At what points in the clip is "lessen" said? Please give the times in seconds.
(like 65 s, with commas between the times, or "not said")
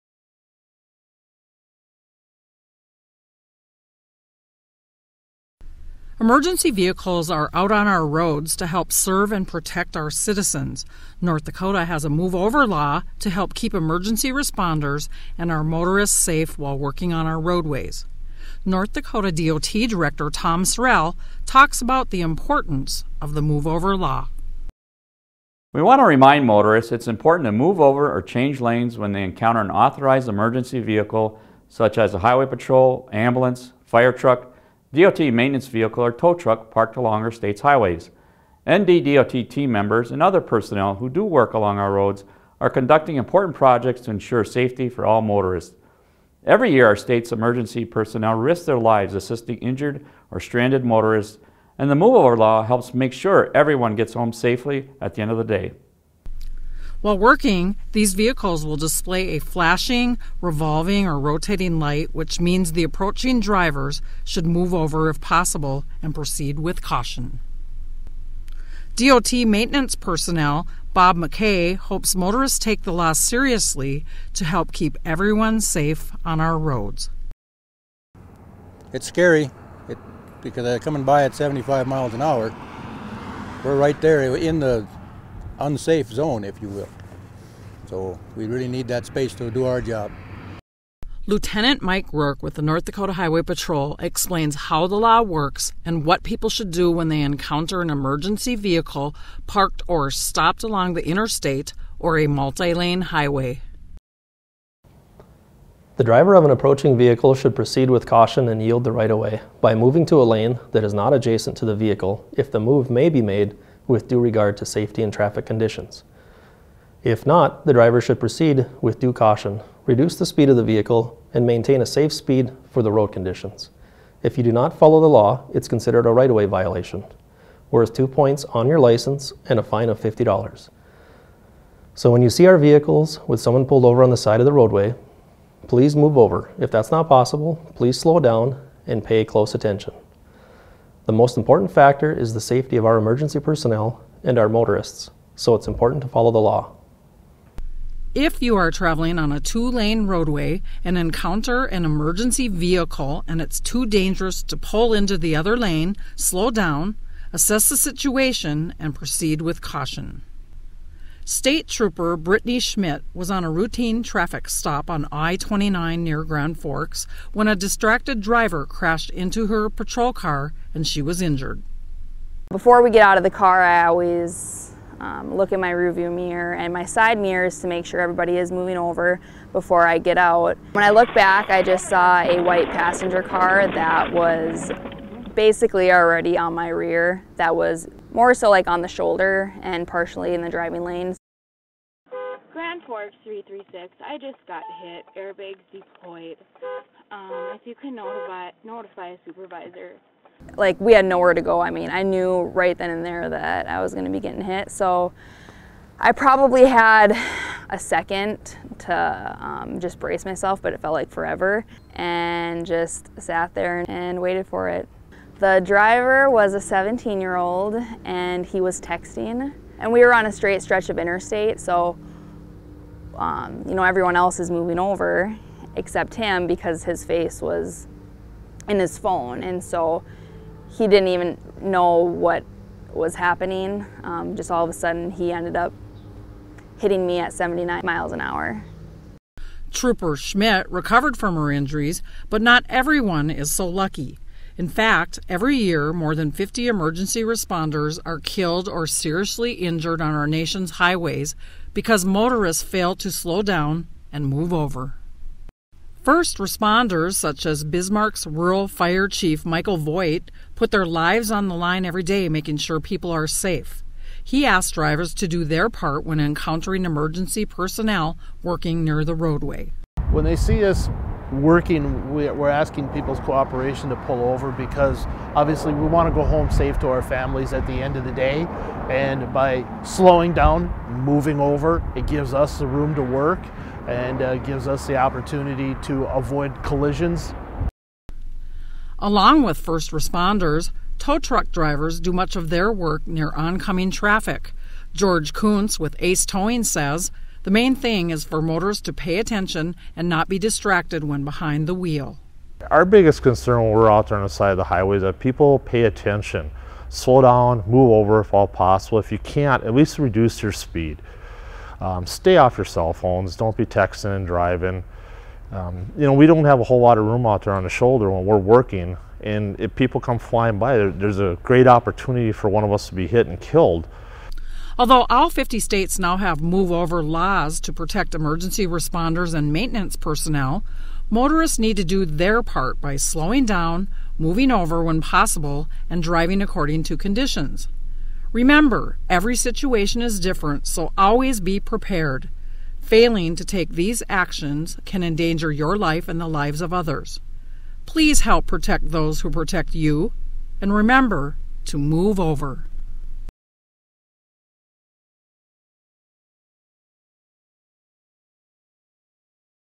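not said.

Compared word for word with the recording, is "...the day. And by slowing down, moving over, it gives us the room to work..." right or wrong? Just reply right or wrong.
right.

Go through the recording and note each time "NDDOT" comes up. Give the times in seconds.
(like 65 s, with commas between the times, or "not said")
38 s.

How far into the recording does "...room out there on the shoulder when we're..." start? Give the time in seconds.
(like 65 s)
317 s.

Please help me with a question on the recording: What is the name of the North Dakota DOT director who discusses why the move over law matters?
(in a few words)
Tom Sorel.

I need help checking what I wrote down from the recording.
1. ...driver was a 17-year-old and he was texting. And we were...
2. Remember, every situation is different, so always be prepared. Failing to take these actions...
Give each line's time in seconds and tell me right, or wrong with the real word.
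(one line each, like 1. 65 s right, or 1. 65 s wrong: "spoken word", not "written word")
1. 215 s right
2. 338 s right.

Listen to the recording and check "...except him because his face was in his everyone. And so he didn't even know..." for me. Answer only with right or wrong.
wrong.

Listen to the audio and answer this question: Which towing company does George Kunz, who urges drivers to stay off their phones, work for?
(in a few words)
Ace Towing.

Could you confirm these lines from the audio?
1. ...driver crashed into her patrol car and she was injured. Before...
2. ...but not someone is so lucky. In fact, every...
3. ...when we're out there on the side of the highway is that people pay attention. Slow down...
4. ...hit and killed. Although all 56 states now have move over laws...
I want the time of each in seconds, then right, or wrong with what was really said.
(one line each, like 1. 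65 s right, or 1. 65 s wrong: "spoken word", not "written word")
1. 168 s right
2. 242 s wrong: "everyone", not "someone"
3. 303 s right
4. 323 s wrong: "50", not "56".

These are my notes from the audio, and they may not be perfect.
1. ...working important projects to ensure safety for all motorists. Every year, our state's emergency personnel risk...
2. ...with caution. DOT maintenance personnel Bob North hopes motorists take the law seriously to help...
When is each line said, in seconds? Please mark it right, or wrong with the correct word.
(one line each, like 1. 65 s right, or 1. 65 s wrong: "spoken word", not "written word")
1. 42 s wrong: "conducting", not "working"
2. 66 s wrong: "McKay", not "North".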